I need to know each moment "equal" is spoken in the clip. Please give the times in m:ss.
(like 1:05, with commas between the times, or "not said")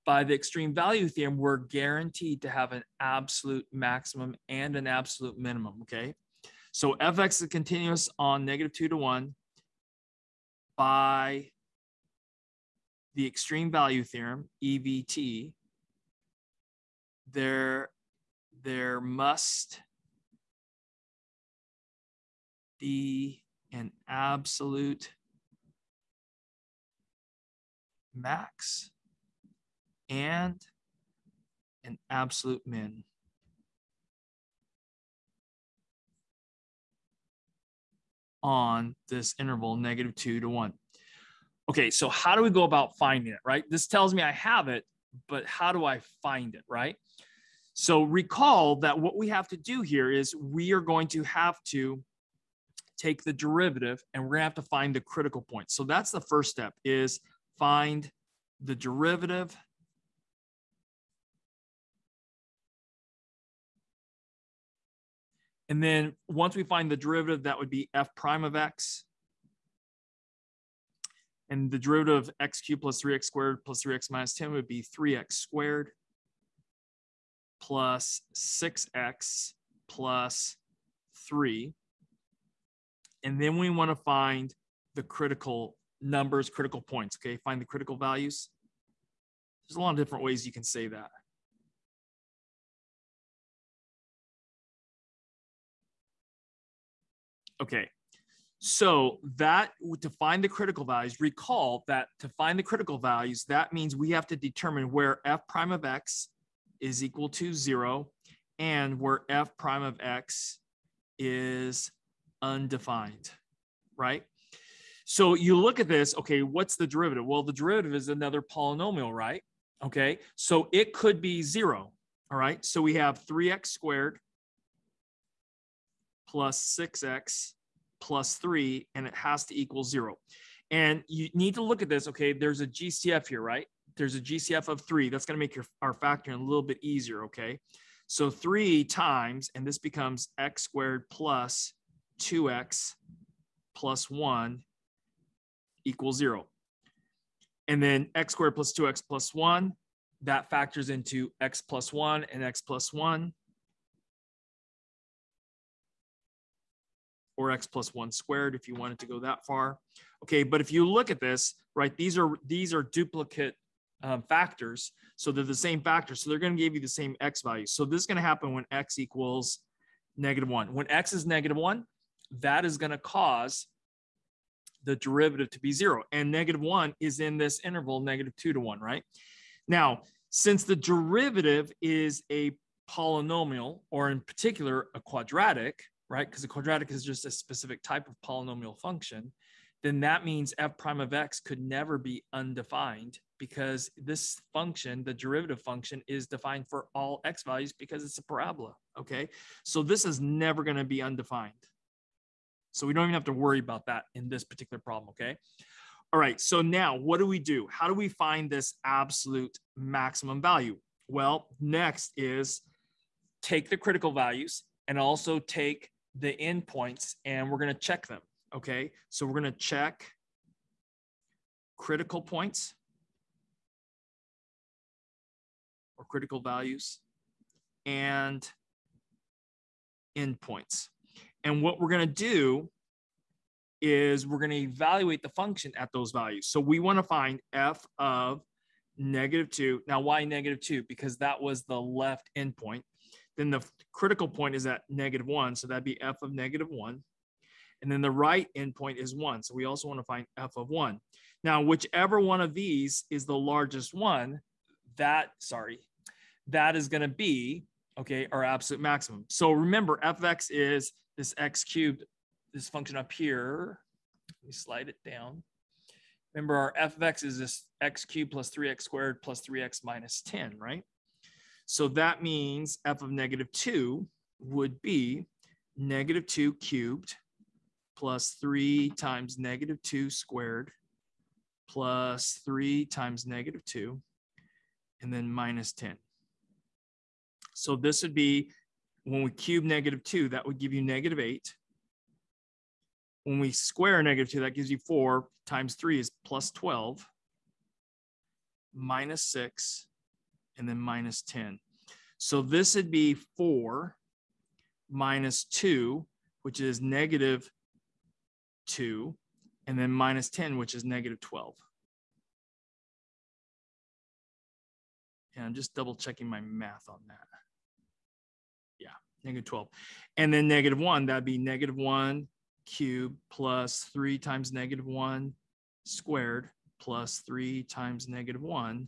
1:47, 2:09, 2:25, 2:48.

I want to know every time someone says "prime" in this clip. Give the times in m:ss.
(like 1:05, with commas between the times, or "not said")
1:08, 1:45, 1:49, 3:10.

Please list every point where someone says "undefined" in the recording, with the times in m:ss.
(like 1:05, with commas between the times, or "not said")
1:52, 3:12, 3:21.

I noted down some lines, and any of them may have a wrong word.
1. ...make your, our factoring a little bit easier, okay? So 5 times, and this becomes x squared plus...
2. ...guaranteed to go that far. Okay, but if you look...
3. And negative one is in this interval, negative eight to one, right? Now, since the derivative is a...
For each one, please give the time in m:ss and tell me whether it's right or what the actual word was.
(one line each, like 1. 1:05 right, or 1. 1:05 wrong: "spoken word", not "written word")
1. 2:15 wrong: "3", not "5"
2. 2:38 wrong: "wanted", not "guaranteed"
3. 2:56 wrong: "two", not "eight".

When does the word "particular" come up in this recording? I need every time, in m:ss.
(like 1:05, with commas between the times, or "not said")
3:04, 3:24.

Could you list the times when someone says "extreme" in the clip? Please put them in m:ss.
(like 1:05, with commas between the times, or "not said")
0:00, 0:13.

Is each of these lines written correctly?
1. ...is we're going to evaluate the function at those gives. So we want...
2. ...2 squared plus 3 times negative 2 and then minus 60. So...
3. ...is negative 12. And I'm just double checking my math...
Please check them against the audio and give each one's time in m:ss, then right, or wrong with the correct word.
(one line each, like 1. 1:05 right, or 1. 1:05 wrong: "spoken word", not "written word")
1. 3:53 wrong: "values", not "gives"
2. 4:39 wrong: "10", not "60"
3. 5:10 right.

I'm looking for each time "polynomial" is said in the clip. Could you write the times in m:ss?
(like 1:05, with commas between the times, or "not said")
1:58, 3:02, 3:08.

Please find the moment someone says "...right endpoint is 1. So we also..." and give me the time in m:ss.
4:08.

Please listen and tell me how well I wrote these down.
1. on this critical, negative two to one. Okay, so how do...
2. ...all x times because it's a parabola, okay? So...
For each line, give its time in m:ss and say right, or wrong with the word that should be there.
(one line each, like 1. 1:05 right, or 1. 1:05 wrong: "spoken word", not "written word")
1. 0:38 wrong: "interval", not "critical"
2. 3:16 wrong: "values", not "times".